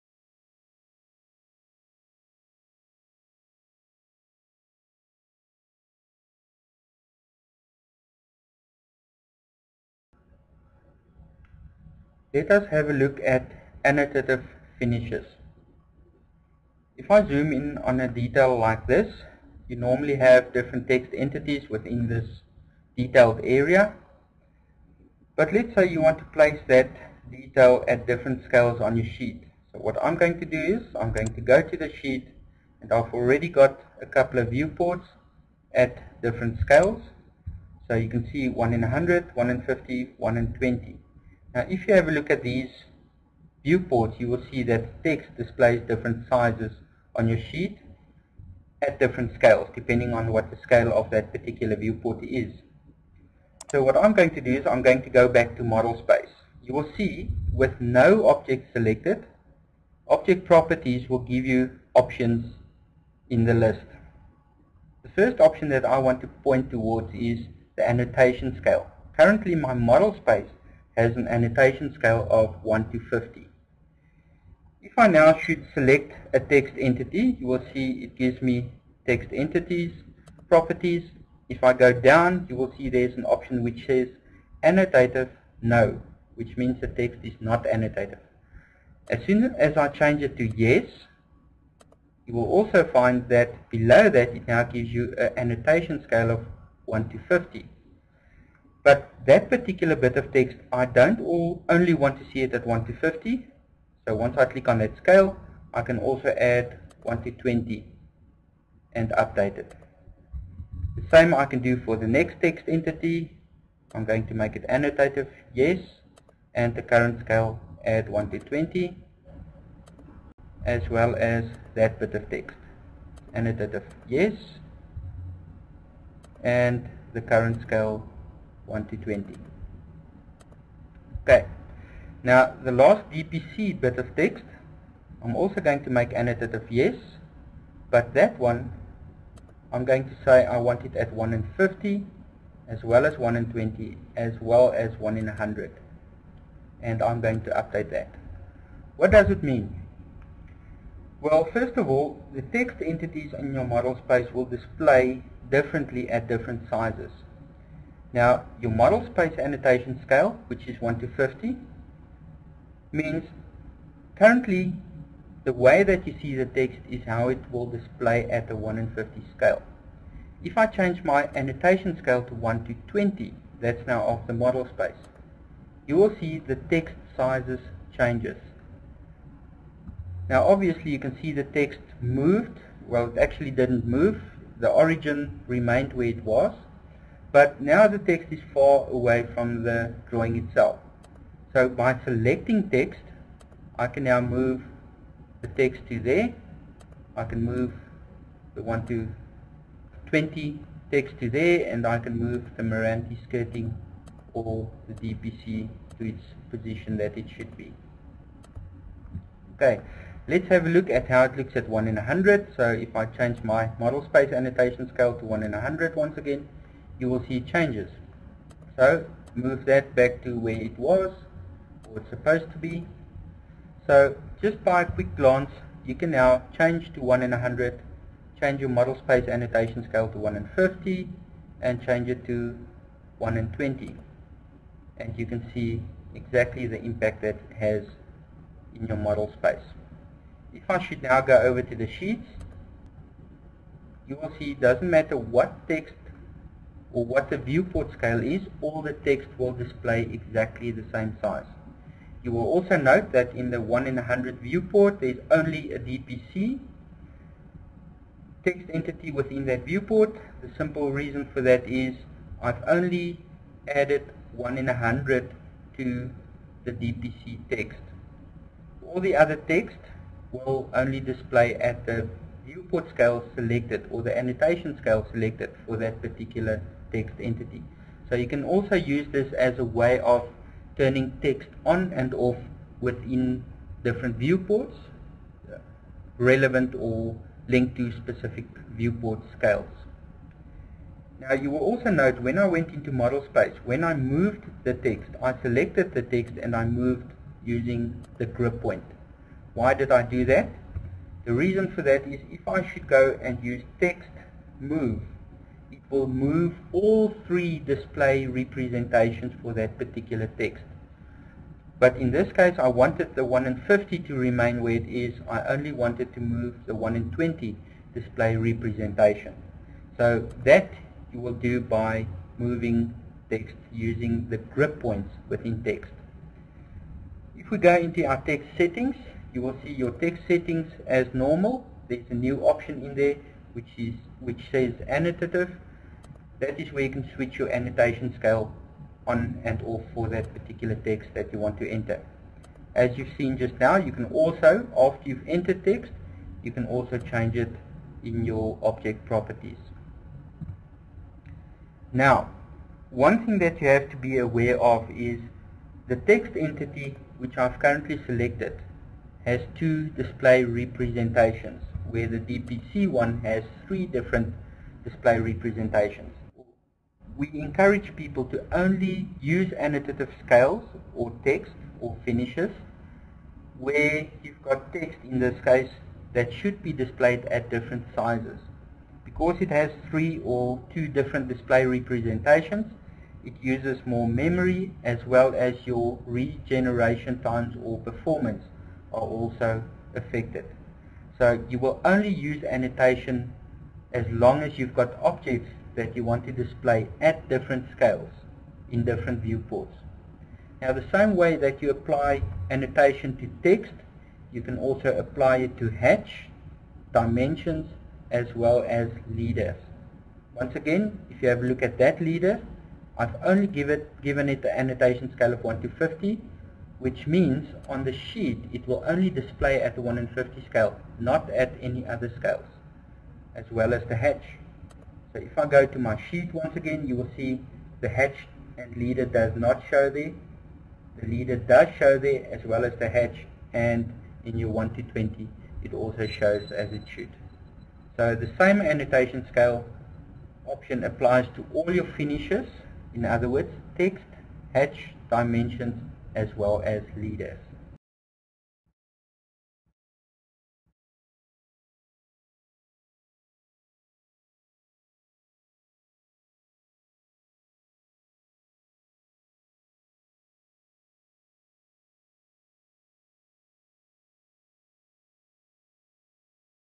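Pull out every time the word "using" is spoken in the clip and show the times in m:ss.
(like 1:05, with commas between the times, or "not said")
4:57, 5:23.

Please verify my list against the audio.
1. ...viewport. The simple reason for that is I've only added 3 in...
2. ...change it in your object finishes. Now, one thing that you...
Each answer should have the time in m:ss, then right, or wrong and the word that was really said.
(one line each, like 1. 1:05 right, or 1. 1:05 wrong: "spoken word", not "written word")
1. 4:19 wrong: "1", not "3"
2. 5:46 wrong: "properties", not "finishes".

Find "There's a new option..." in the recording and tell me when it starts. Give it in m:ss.
5:31.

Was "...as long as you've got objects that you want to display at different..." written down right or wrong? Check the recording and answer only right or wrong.
right.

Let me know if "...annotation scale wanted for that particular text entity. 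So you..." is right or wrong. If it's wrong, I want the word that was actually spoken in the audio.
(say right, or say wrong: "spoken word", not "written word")
wrong: "selected", not "wanted".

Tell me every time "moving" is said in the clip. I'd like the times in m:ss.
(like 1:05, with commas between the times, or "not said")
5:22.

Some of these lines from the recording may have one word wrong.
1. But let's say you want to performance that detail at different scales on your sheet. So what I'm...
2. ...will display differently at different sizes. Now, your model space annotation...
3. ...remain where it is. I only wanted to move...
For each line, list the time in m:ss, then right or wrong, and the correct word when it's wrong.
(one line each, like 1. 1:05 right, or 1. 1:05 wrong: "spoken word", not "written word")
1. 0:25 wrong: "place", not "performance"
2. 2:34 right
3. 5:14 right.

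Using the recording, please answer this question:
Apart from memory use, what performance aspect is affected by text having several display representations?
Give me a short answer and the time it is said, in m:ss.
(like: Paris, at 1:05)
Regeneration times, at 6:26.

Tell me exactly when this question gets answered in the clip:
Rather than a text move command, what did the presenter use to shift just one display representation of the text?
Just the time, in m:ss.
4:58.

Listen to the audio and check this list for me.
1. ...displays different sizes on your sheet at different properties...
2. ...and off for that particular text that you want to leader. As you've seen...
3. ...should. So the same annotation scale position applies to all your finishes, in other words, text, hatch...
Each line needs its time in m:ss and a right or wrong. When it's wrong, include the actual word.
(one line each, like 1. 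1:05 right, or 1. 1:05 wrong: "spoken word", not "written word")
1. 0:45 wrong: "scales", not "properties"
2. 5:39 wrong: "enter", not "leader"
3. 7:16 wrong: "option", not "position".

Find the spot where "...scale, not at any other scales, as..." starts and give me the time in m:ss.
7:00.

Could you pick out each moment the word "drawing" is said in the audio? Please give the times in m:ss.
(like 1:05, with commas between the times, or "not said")
3:10.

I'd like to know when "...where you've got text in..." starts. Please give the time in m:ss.
6:13.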